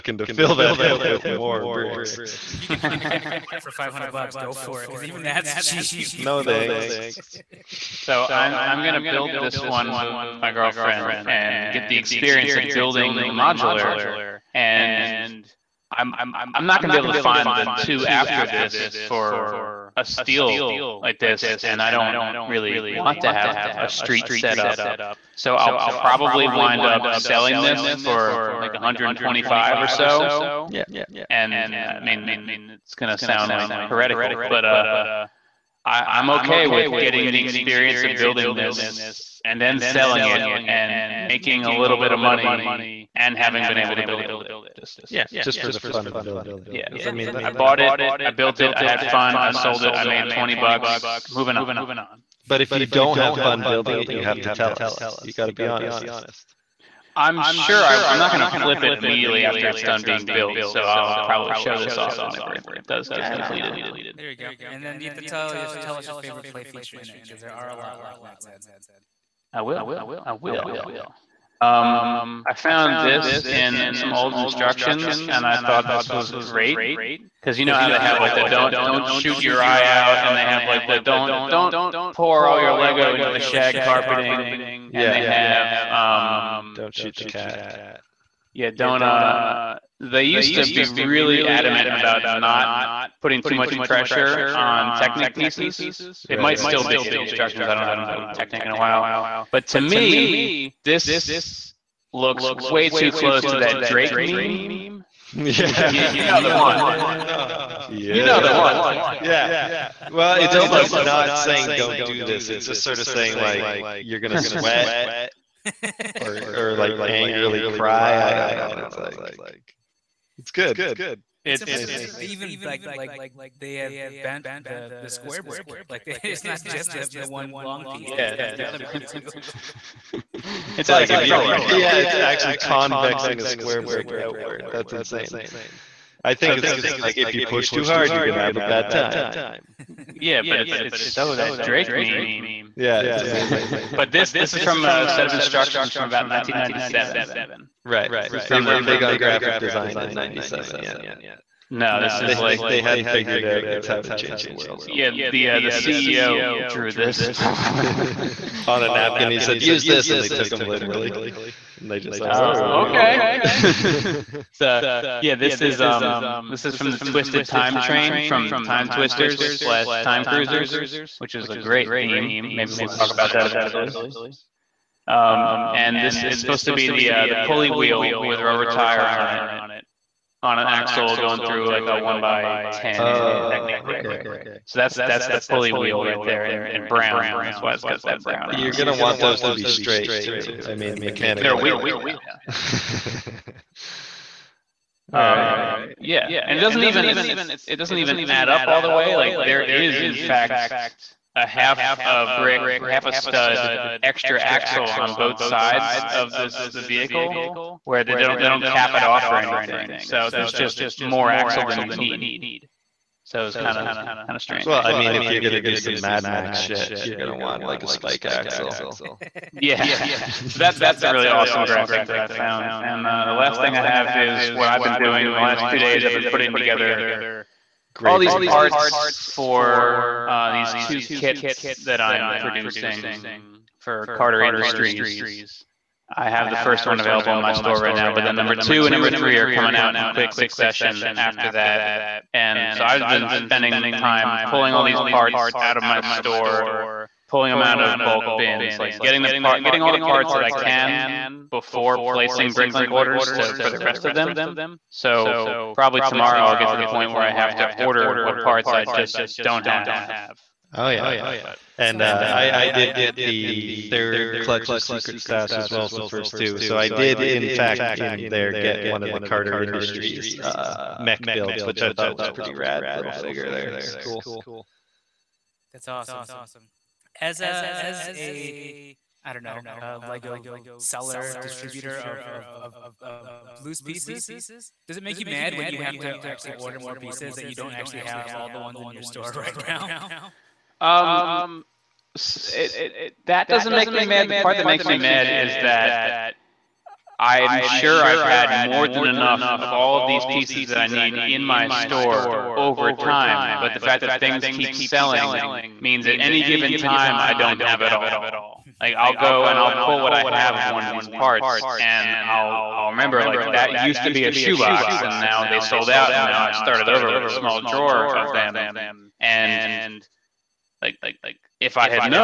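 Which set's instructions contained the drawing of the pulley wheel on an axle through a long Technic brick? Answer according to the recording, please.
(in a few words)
Twisted Time Train.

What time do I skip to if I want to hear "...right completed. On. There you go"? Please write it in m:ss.
1:03.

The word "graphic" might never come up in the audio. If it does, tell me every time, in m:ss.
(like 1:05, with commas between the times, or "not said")
2:29, 3:41.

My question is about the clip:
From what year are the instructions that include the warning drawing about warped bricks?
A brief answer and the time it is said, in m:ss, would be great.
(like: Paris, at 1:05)
1997, at 2:26.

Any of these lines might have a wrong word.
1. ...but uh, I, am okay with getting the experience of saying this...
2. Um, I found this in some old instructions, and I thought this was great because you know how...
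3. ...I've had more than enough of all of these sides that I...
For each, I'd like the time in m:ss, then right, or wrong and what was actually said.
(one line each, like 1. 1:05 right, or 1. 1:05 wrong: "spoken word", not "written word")
1. 0:34 wrong: "building", not "saying"
2. 1:11 right
3. 4:58 wrong: "pieces", not "sides".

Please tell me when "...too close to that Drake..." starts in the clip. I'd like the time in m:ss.
1:42.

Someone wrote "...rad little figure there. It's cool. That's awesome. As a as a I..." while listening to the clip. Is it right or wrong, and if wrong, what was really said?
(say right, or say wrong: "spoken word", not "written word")
right.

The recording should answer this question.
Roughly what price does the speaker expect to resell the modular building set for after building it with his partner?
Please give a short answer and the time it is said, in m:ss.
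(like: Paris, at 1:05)
125, at 0:28.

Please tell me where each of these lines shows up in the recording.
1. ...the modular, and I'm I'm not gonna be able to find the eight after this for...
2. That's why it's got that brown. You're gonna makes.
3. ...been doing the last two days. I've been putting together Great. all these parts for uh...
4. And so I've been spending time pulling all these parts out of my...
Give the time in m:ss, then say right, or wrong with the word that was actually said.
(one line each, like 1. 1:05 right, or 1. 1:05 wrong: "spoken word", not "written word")
1. 0:13 wrong: "two", not "eight"
2. 3:07 wrong: "sides", not "makes"
3. 3:44 right
4. 4:02 right.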